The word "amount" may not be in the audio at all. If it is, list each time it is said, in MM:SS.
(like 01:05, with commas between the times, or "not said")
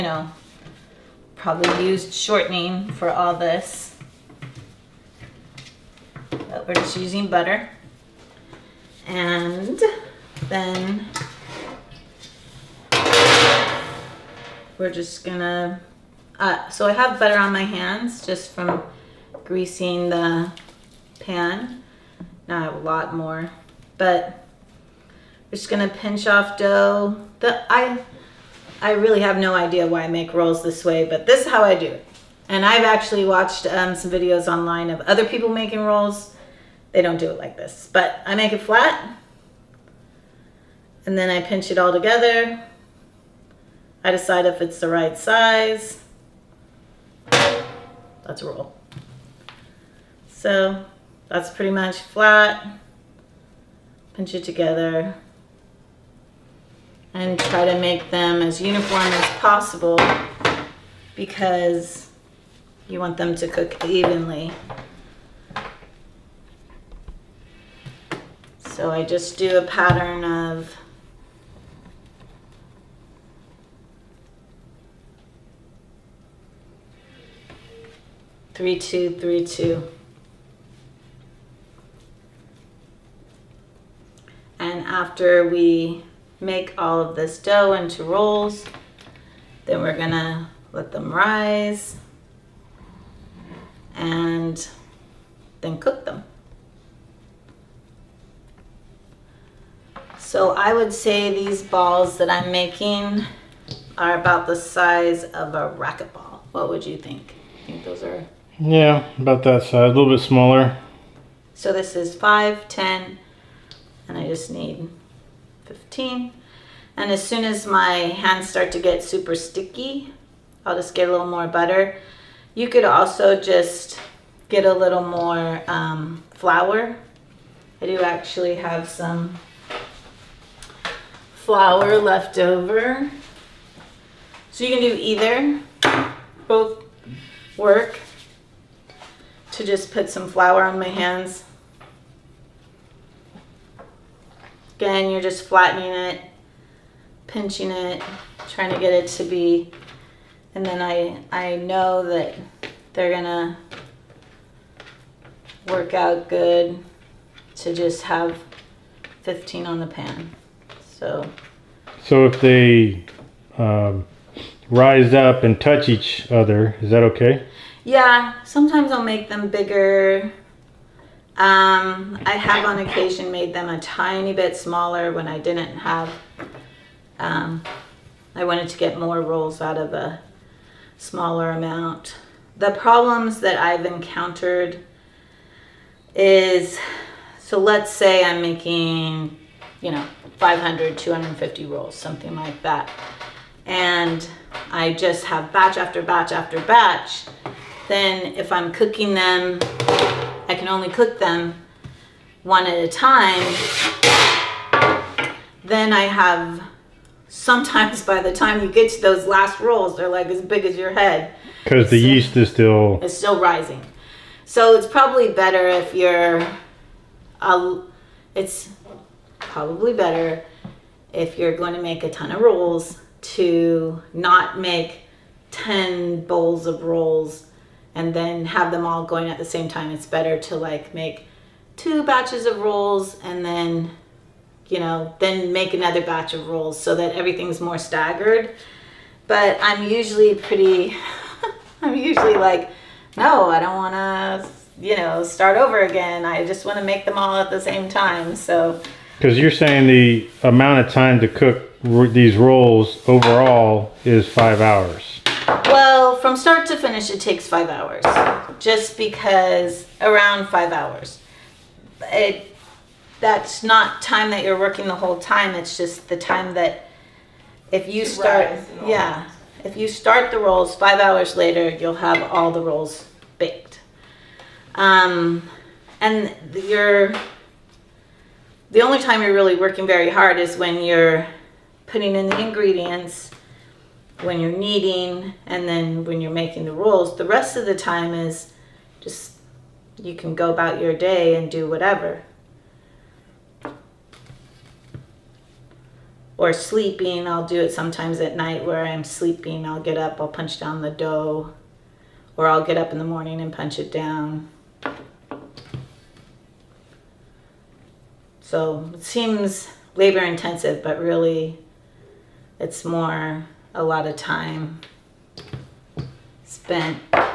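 03:01, 04:10.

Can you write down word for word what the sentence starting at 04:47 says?
The rest of the time is just you can go about your day and do whatever.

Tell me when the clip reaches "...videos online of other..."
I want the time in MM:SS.
00:34.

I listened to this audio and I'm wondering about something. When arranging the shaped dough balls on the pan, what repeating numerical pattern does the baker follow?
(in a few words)
3, 2, 3, 2.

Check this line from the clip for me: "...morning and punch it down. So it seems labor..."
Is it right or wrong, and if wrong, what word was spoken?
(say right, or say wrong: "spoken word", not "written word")
right.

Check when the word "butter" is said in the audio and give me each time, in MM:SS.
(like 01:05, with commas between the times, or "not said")
00:07, 00:17, 02:01.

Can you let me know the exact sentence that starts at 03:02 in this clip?
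The problems that I've encountered is, so let's say I'm making, you know, 500, 250 rolls, something like that.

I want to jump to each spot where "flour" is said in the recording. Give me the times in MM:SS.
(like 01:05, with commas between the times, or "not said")
02:06, 02:11, 02:20.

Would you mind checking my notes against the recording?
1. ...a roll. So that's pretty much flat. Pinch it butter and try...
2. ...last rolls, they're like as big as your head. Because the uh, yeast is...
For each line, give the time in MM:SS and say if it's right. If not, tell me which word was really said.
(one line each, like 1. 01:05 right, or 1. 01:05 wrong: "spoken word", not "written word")
1. 00:48 wrong: "together", not "butter"
2. 03:29 right.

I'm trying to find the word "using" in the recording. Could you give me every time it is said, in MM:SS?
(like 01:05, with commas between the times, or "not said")
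00:06.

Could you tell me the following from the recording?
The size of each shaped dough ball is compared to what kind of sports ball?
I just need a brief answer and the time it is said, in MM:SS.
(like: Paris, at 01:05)
racquetball, at 01:45.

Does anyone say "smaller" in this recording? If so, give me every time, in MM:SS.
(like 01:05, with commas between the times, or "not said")
01:50, 02:54, 03:00.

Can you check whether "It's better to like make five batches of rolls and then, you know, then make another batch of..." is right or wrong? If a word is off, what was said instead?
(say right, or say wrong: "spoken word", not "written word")
wrong: "two", not "five".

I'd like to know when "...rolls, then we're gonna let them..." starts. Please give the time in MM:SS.
01:28.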